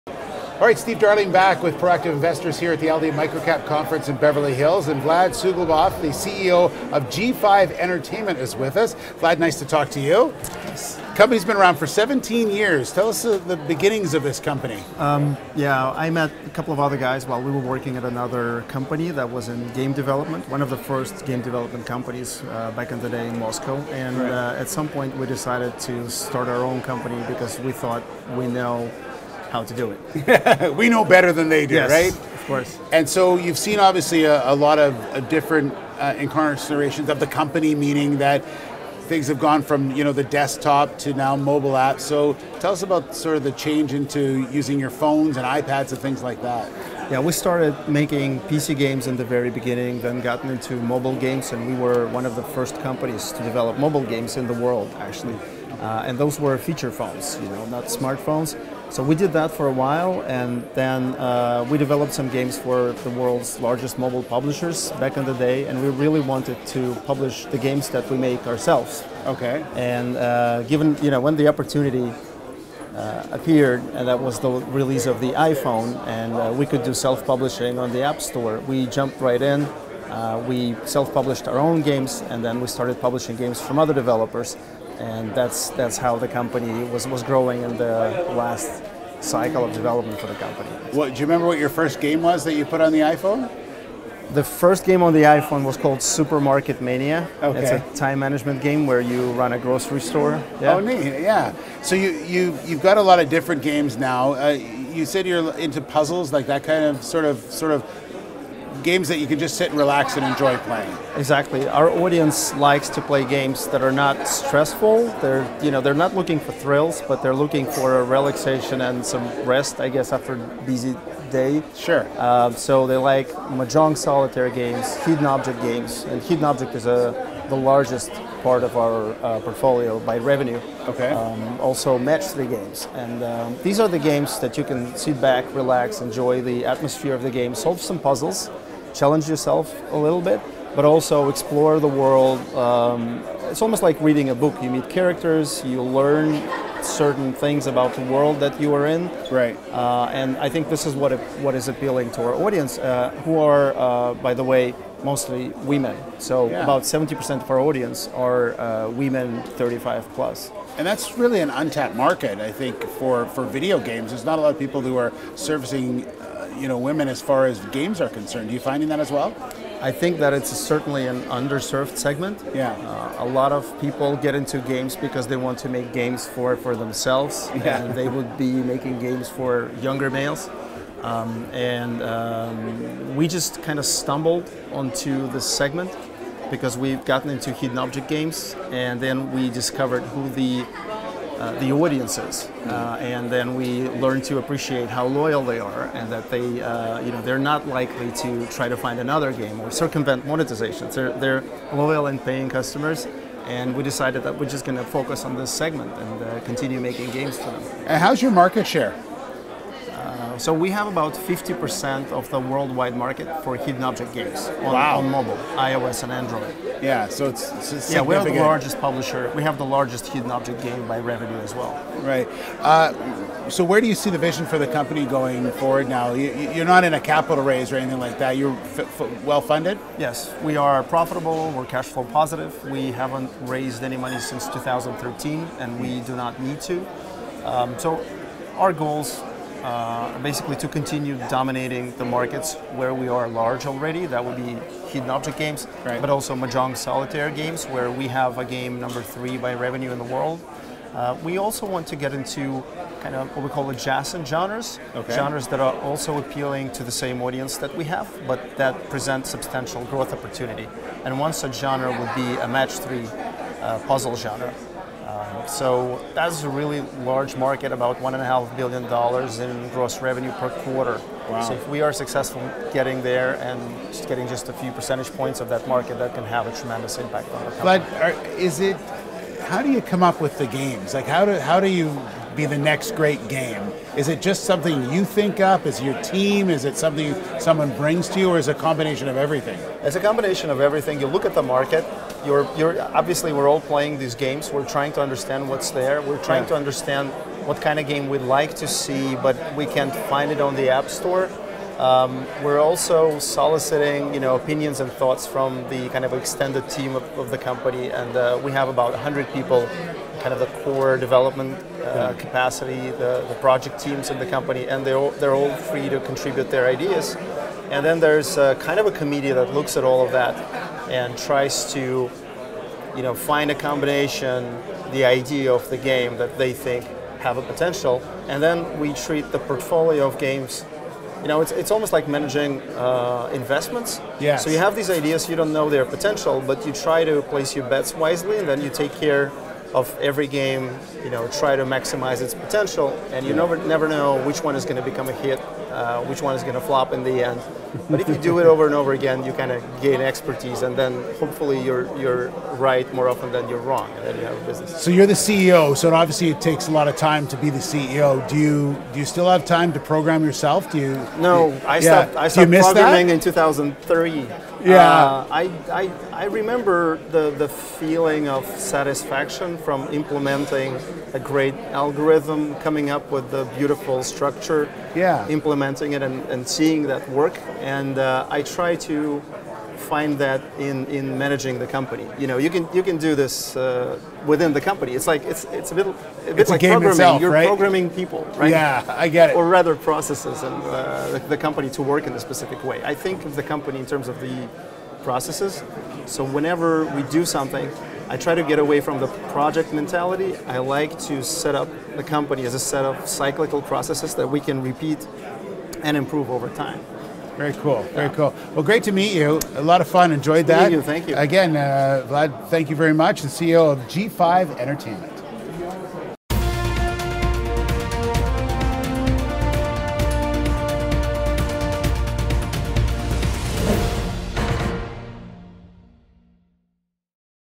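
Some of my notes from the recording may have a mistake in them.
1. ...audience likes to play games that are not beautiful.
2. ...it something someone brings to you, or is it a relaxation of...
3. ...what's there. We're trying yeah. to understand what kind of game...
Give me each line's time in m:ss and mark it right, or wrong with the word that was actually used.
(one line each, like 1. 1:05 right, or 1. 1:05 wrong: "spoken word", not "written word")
1. 1:51 wrong: "stressful", not "beautiful"
2. 4:46 wrong: "combination", not "relaxation"
3. 4:55 right.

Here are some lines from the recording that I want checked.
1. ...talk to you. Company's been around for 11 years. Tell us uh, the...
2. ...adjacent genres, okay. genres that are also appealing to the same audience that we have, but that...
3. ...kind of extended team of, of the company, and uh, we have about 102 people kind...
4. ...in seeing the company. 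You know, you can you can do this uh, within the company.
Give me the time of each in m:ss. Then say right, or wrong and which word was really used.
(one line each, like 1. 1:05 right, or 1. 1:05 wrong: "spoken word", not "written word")
1. 0:09 wrong: "17", not "11"
2. 4:13 right
3. 5:05 wrong: "100", not "102"
4. 6:20 wrong: "managing", not "seeing".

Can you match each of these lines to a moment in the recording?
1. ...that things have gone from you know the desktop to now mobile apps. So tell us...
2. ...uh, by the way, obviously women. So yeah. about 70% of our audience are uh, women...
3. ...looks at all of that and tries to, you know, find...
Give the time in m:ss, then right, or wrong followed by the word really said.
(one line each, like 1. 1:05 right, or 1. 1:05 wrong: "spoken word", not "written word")
1. 0:38 right
2. 2:33 wrong: "mostly", not "obviously"
3. 5:19 right.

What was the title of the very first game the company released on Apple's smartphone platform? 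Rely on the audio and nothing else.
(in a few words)
Supermarket Mania.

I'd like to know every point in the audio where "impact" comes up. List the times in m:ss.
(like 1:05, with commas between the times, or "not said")
4:36.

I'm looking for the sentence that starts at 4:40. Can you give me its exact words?
Like how do, how do you be the next great game?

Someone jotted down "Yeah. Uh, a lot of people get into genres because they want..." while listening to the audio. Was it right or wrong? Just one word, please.
wrong.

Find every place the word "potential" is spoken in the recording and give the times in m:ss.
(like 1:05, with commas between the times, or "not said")
5:27, 5:35, 5:42.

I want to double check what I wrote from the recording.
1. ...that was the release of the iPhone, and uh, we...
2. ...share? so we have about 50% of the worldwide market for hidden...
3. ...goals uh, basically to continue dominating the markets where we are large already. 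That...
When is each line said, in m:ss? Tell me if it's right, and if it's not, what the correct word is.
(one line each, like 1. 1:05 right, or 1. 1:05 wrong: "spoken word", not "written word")
1. 1:14 right
2. 3:28 right
3. 3:58 right.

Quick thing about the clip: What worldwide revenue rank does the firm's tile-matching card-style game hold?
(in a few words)
Number three.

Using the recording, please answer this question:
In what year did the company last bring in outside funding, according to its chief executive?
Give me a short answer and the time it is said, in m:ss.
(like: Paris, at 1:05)
2013, at 3:54.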